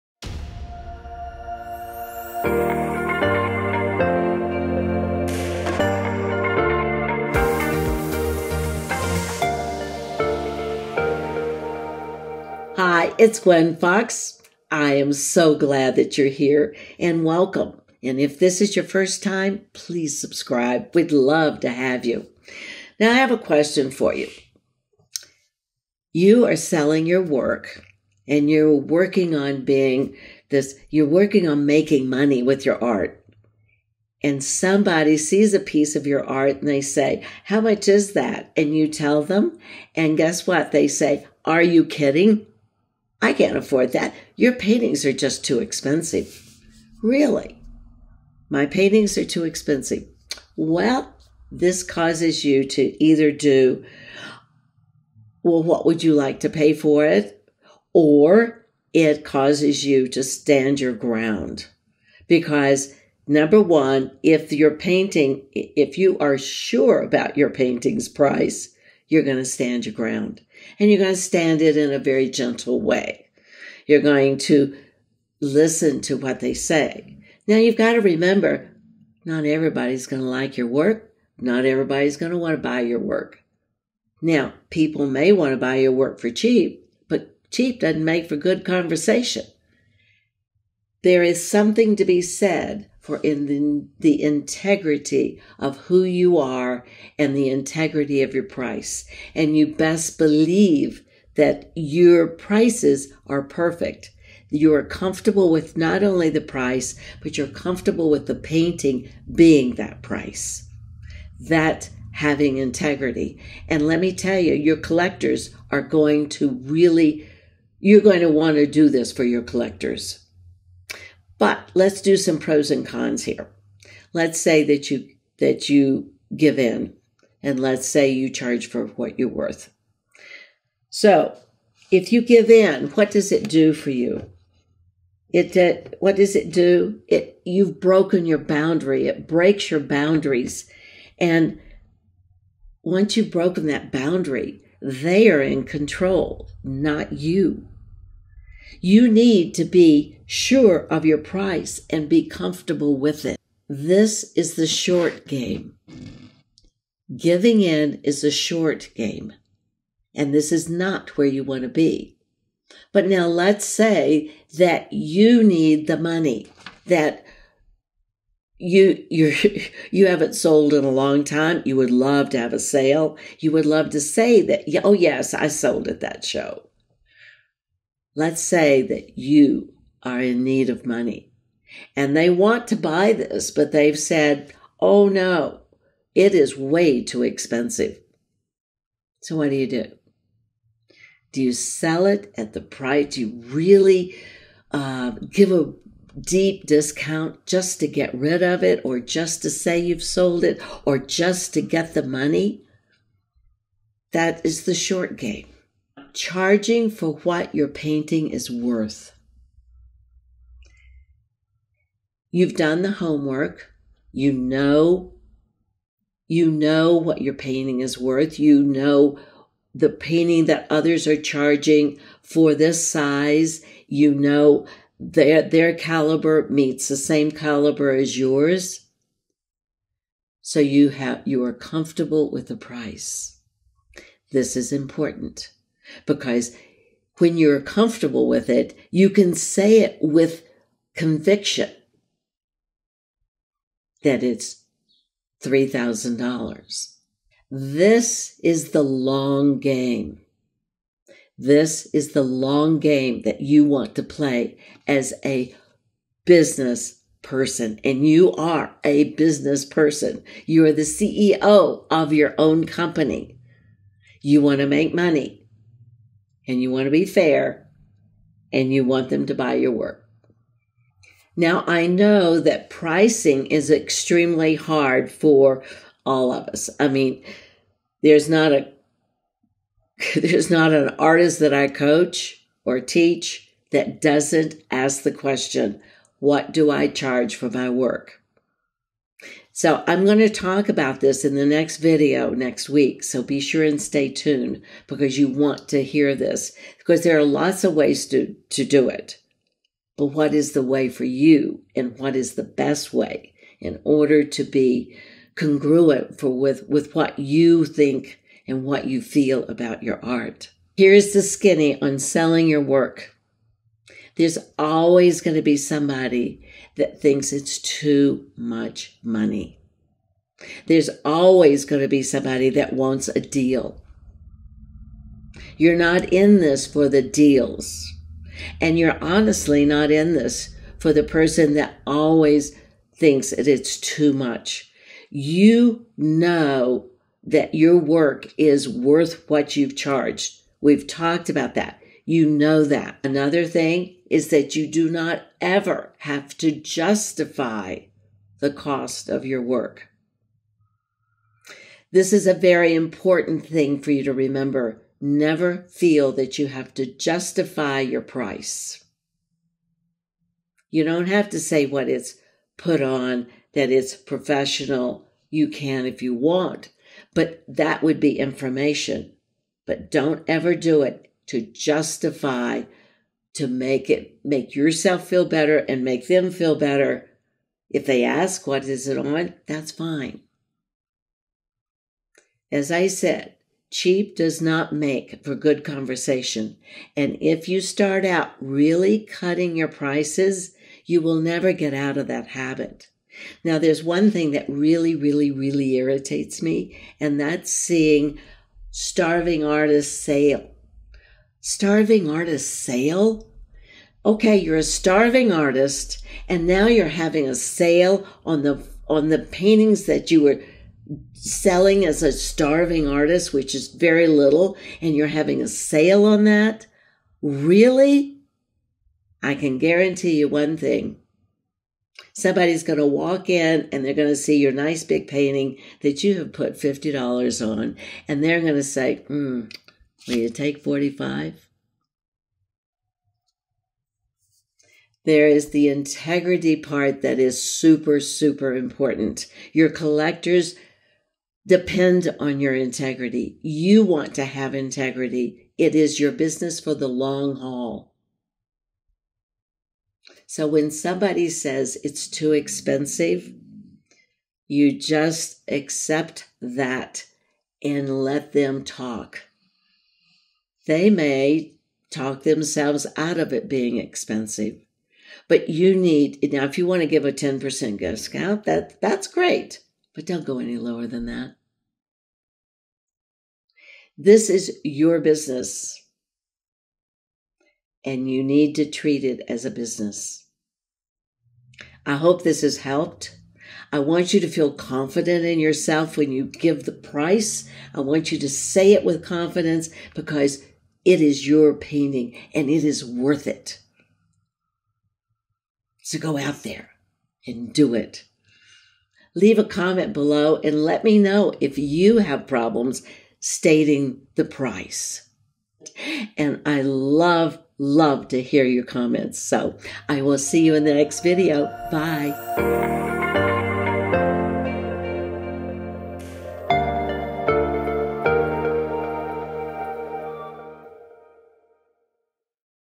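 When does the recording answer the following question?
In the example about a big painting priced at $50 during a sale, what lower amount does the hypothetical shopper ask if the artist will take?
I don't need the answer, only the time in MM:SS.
07:10.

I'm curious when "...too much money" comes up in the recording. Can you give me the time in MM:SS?
05:17.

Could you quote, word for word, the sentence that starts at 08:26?
And I love, love to hear your comments.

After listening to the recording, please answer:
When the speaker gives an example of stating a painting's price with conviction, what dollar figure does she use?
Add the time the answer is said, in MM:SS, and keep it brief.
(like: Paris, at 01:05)
$3,000, at 04:05.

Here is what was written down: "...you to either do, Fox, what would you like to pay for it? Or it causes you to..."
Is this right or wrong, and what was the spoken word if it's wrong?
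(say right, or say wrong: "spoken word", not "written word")
wrong: "Well", not "Fox".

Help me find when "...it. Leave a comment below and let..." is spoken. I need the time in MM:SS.
08:17.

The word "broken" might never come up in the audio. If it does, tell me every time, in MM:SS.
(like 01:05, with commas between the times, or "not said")
02:17, 02:23.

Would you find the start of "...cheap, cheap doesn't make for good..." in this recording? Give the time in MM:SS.
01:26.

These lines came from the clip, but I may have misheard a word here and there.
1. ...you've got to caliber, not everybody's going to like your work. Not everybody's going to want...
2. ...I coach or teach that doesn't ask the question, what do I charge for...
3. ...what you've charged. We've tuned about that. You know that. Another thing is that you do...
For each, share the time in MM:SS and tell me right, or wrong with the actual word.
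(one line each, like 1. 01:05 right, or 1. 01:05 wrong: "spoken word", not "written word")
1. 01:17 wrong: "remember", not "caliber"
2. 04:41 right
3. 05:39 wrong: "talked", not "tuned".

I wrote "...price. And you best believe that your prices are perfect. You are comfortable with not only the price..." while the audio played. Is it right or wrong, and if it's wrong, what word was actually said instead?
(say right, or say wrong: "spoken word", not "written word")
right.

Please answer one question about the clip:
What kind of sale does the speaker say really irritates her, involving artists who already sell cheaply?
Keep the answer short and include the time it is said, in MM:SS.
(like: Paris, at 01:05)
starving artists sale, at 06:38.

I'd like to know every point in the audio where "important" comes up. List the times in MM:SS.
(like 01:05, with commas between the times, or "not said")
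03:54, 05:52, 07:18.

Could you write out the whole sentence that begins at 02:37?
Giving in is a short game.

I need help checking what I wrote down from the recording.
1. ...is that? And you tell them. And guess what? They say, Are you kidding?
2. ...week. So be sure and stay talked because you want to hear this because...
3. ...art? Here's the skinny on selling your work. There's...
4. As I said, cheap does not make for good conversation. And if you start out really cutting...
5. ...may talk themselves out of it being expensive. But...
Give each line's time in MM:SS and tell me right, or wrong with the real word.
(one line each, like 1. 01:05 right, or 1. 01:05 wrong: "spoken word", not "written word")
1. 00:37 right
2. 04:52 wrong: "tuned", not "talked"
3. 05:10 right
4. 06:22 right
5. 07:40 right.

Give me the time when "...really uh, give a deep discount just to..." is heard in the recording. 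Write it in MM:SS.
03:13.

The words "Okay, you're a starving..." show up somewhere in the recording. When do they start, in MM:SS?
06:44.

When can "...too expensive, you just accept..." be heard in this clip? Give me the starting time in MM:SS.
07:32.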